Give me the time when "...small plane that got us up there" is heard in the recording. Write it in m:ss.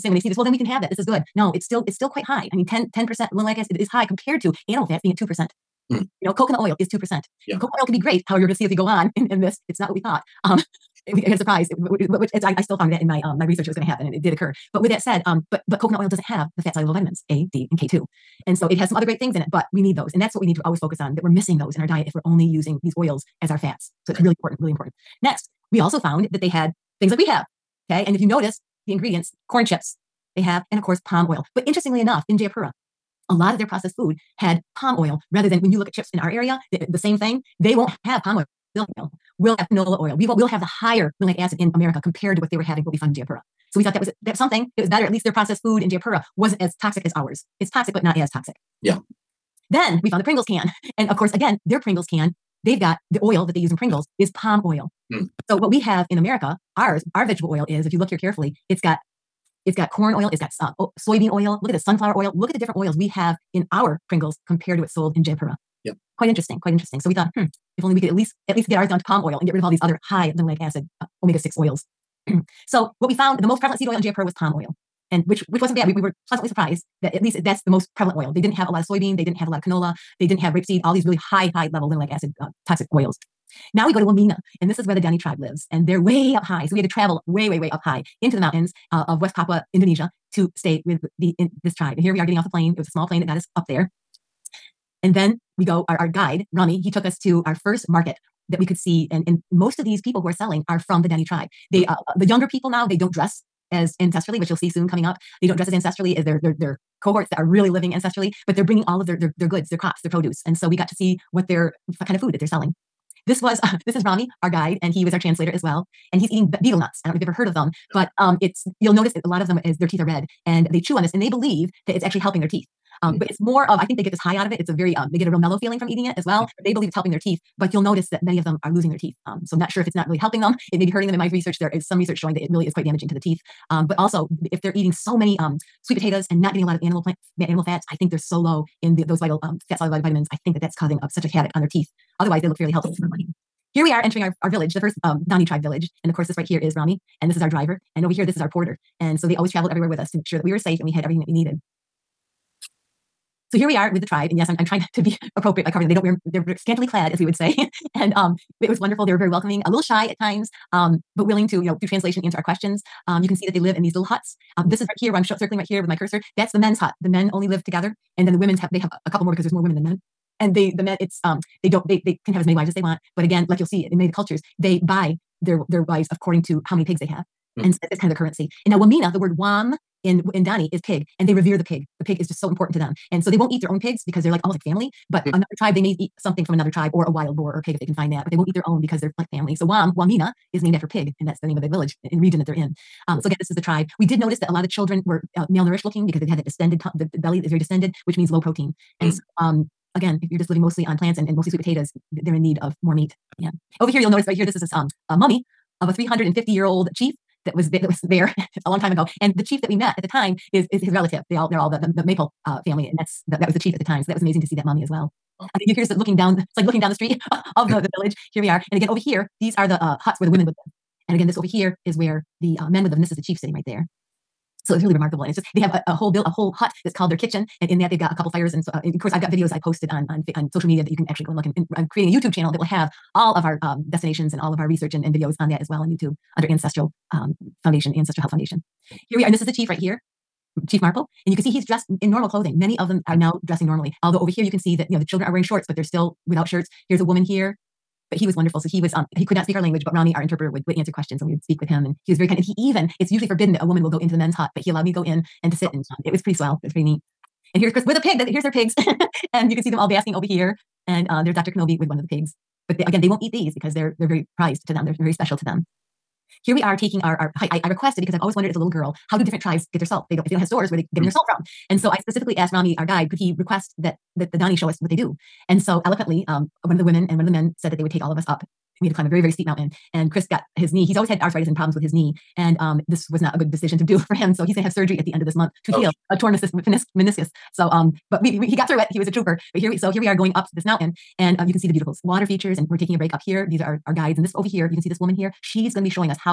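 1:32.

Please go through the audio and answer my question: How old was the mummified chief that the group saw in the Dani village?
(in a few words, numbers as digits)
350 years.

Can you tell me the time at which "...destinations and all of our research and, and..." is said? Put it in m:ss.
3:53.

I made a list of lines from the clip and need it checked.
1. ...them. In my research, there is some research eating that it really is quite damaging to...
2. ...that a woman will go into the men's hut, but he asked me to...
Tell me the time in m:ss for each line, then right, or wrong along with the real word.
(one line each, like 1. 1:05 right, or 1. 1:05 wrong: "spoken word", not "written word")
1. 2:11 wrong: "showing", not "eating"
2. 4:13 wrong: "allowed", not "asked".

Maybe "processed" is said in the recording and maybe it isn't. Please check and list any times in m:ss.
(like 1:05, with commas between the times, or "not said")
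0:33, 0:45.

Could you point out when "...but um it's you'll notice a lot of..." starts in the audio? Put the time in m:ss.
1:57.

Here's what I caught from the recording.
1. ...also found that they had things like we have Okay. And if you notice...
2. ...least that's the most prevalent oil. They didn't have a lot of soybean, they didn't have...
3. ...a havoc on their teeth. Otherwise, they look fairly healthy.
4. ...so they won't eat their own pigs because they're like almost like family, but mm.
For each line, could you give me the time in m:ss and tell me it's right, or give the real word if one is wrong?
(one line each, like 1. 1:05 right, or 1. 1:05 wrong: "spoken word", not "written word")
1. 0:25 right
2. 1:17 right
3. 2:21 right
4. 3:03 right.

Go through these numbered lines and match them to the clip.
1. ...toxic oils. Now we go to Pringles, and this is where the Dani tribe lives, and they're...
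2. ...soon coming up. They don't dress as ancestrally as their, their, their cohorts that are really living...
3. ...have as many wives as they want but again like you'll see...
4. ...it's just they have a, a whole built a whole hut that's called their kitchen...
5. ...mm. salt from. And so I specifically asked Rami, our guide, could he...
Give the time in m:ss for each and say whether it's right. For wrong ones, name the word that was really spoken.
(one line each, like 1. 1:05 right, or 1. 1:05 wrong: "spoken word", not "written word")
1. 1:22 wrong: "Wamena", not "Pringles"
2. 1:44 right
3. 2:52 right
4. 3:45 right
5. 4:31 right.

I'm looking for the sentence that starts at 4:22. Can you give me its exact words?
But they, again, they won't eat these because they're they're very prized to them.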